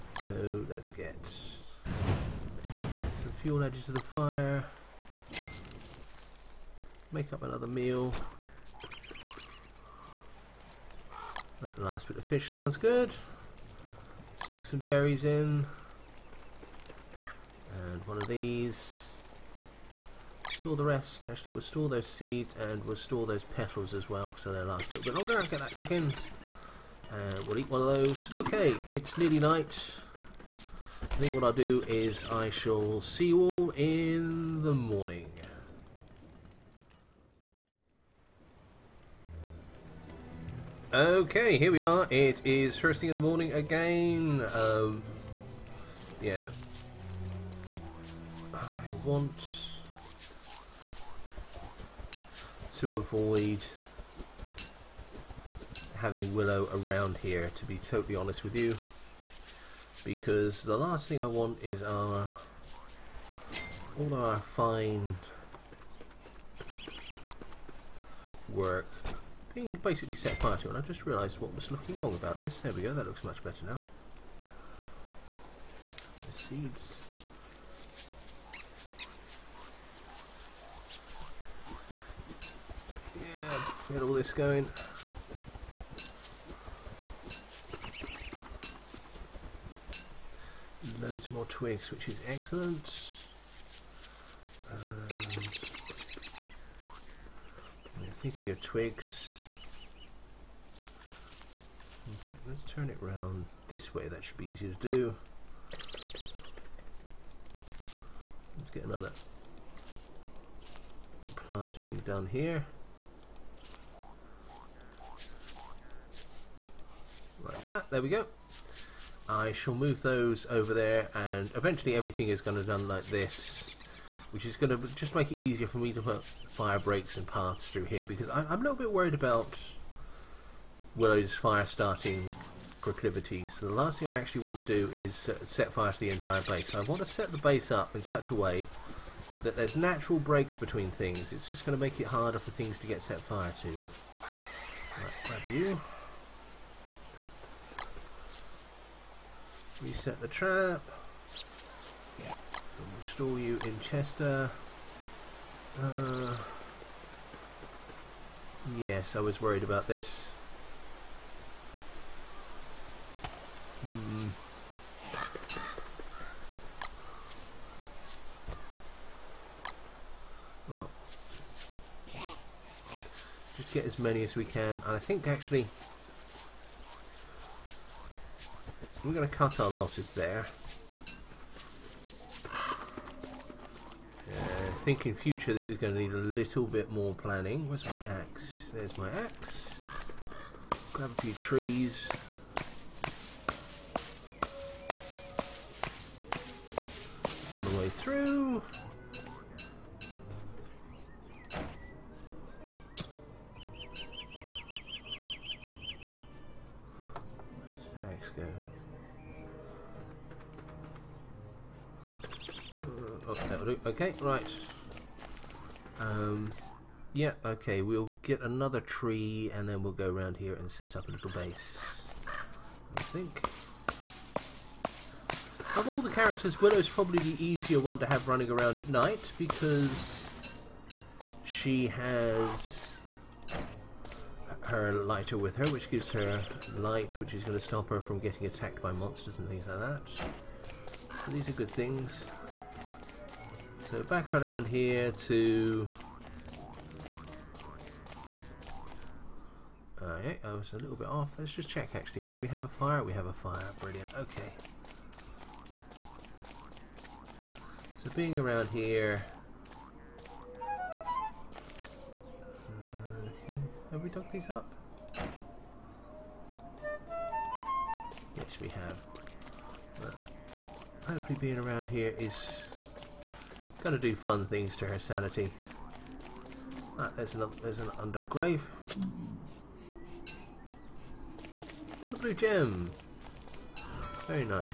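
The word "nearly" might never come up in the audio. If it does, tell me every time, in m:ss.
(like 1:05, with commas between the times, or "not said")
0:29.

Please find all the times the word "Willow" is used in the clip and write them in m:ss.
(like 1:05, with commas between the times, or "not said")
0:56, 2:10, 3:46.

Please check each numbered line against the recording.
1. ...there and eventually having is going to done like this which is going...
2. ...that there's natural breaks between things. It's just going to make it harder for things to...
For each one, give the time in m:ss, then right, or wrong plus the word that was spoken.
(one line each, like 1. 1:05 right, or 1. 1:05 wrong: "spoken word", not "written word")
1. 2:00 wrong: "everything", not "having"
2. 2:19 right.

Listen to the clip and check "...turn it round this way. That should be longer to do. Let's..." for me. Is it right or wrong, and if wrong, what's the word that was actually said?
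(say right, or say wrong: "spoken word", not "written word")
wrong: "easier", not "longer".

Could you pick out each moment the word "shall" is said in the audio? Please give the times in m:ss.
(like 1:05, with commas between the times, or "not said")
0:32, 1:59.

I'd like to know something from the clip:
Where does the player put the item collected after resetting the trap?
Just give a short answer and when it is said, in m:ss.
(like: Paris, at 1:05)
Chester, at 2:33.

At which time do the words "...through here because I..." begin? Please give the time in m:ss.
2:07.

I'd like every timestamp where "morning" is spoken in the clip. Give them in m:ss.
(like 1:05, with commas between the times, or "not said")
0:34, 0:43.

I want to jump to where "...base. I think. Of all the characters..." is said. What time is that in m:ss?
3:41.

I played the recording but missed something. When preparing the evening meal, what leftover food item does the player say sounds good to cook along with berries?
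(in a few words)
Fish.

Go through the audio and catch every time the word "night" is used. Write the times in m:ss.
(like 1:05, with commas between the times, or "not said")
0:29, 3:48.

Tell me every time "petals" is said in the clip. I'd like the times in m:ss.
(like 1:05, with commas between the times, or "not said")
0:23.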